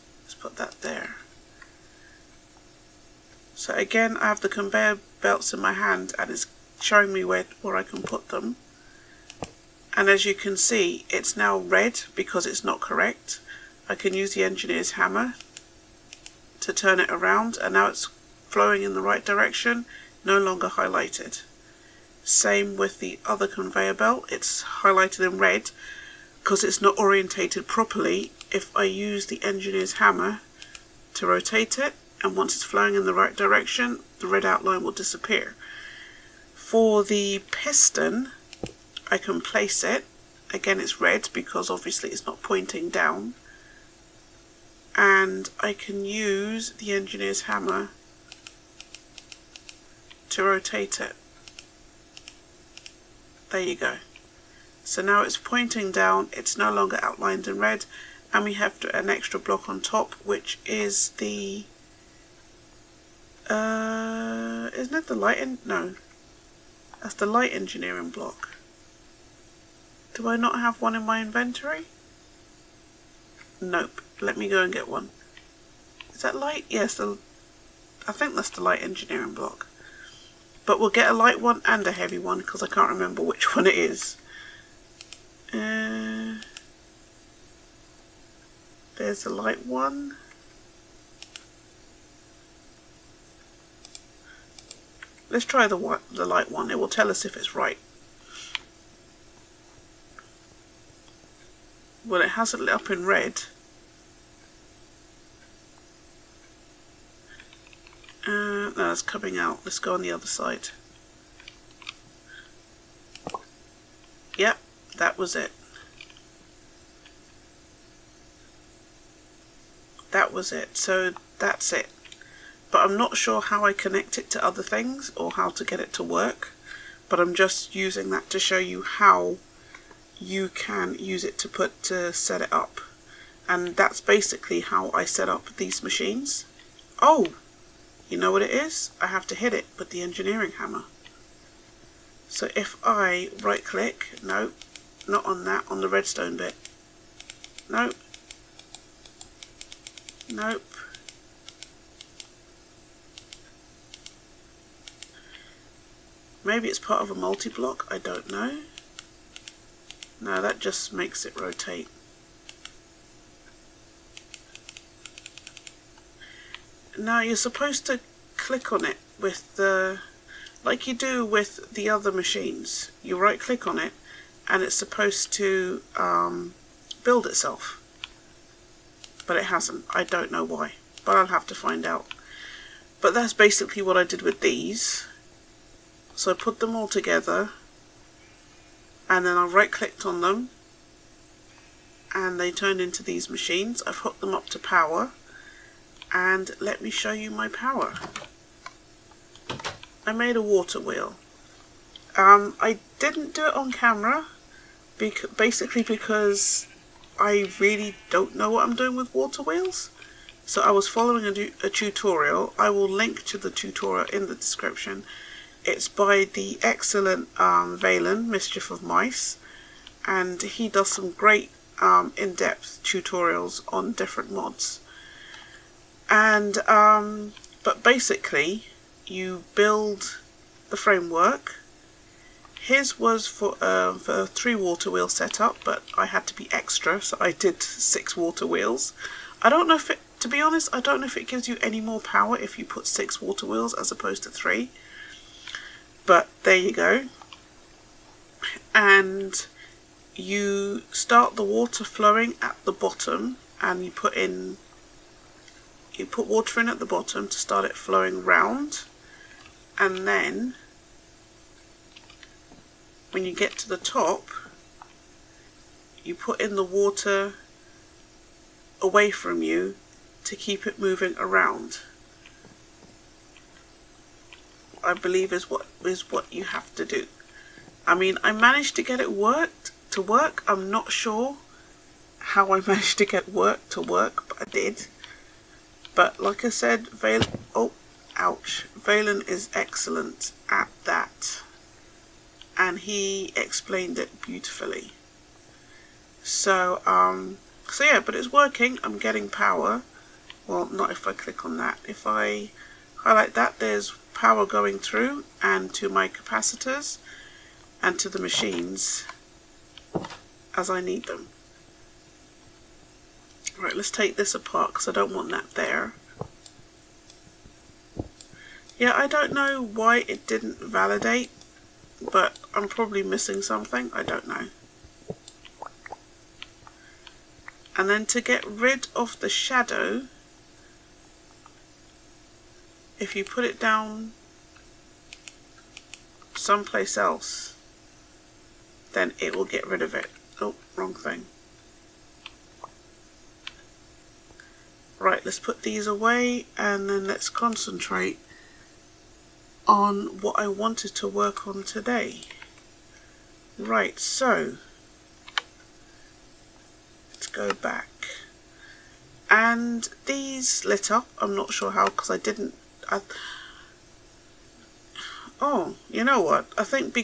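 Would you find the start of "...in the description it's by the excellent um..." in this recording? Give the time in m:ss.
3:34.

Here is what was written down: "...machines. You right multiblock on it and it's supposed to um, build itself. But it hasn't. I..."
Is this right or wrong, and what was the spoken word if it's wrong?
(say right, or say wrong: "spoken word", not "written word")
wrong: "click", not "multiblock".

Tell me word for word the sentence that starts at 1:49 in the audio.
Let's go on the other side.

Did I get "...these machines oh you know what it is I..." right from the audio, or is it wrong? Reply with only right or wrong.
right.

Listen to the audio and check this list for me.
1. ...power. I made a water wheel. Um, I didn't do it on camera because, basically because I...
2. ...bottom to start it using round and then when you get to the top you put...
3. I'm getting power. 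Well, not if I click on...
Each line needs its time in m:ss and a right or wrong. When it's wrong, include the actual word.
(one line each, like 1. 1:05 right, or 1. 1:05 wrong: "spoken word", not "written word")
1. 3:17 right
2. 4:16 wrong: "flowing", not "using"
3. 4:58 right.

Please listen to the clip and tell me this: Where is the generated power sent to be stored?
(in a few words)
Capacitors.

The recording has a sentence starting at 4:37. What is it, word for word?
I mean, I managed to get it worked to work.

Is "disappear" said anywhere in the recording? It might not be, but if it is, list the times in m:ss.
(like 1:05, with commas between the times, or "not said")
0:34.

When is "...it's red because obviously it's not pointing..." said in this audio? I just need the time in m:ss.
0:40.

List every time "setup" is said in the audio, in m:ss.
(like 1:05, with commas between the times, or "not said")
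3:55.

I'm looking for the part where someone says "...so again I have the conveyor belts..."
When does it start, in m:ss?
0:03.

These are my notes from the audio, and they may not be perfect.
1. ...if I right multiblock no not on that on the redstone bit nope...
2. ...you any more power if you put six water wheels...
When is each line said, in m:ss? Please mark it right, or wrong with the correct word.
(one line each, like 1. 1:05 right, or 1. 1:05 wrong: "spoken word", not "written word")
1. 2:22 wrong: "click", not "multiblock"
2. 4:01 right.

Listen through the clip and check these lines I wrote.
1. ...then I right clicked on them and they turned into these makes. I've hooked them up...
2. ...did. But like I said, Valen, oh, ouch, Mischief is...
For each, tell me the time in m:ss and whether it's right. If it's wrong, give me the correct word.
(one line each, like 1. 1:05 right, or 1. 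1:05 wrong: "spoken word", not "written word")
1. 3:09 wrong: "machines", not "makes"
2. 4:44 wrong: "Valen", not "Mischief".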